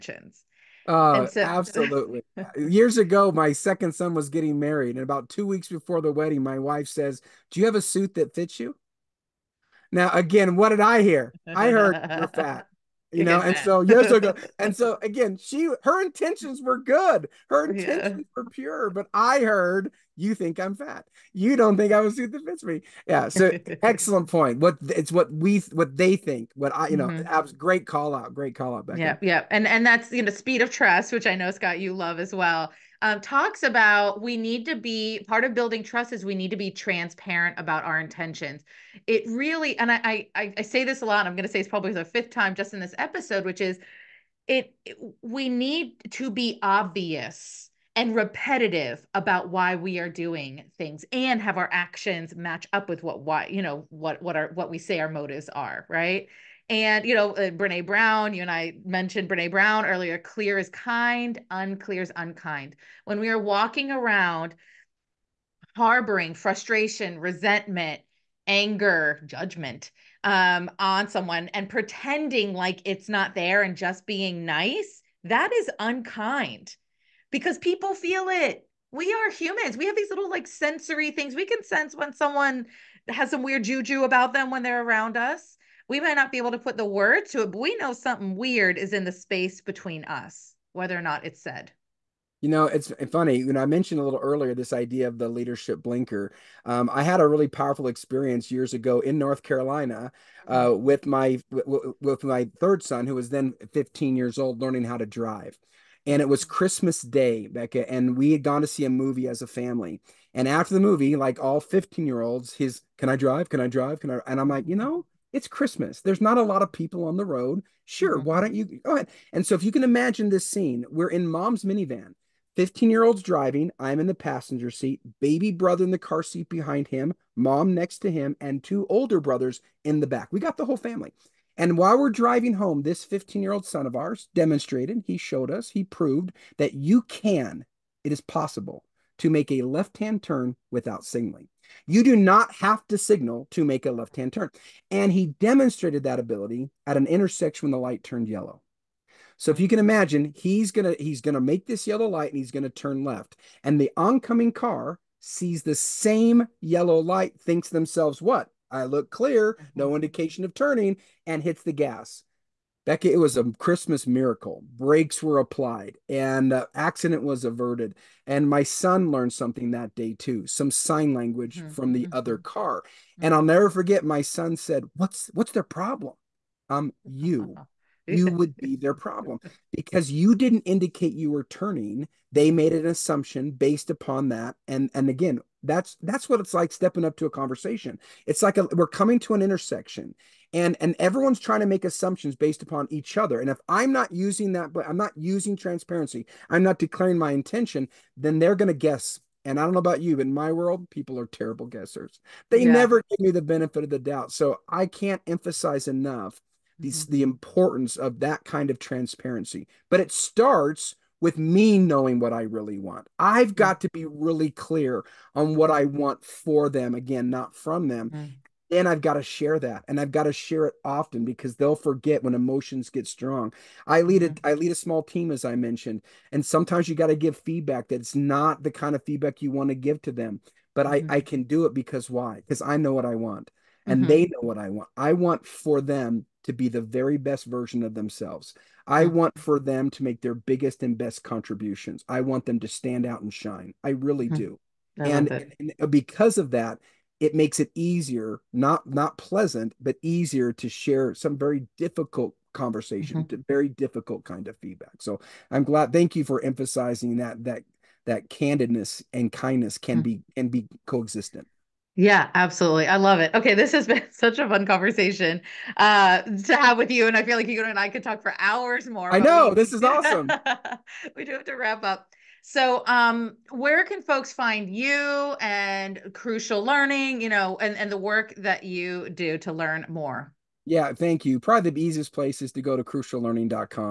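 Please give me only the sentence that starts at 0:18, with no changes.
were pure, but I heard you think I'm fat.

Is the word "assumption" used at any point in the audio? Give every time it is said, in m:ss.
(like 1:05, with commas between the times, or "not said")
3:02, 3:11.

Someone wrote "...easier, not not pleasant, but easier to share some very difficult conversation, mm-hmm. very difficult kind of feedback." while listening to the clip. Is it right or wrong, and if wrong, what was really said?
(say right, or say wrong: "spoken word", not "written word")
right.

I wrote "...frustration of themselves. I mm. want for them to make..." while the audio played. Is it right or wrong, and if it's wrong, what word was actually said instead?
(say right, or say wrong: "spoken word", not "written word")
wrong: "version", not "frustration".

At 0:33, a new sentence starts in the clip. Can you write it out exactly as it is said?
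Um, talks about we need to be part of building trust is we need to be transparent about our intentions.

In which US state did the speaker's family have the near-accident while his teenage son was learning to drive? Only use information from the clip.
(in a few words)
North Carolina.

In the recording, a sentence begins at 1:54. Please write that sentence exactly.
And I'm like, you know, it's Christmas.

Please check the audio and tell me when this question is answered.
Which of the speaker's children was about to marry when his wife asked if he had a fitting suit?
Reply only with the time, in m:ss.
0:03.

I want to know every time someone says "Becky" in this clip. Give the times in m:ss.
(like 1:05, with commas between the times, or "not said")
0:28.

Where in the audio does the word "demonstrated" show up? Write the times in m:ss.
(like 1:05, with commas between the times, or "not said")
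2:14, 2:25.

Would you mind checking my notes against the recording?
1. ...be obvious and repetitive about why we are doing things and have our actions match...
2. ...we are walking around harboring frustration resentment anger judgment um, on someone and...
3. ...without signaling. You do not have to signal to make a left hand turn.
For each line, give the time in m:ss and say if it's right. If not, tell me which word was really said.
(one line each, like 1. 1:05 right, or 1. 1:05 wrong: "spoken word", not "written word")
1. 0:46 right
2. 1:03 right
3. 2:20 right.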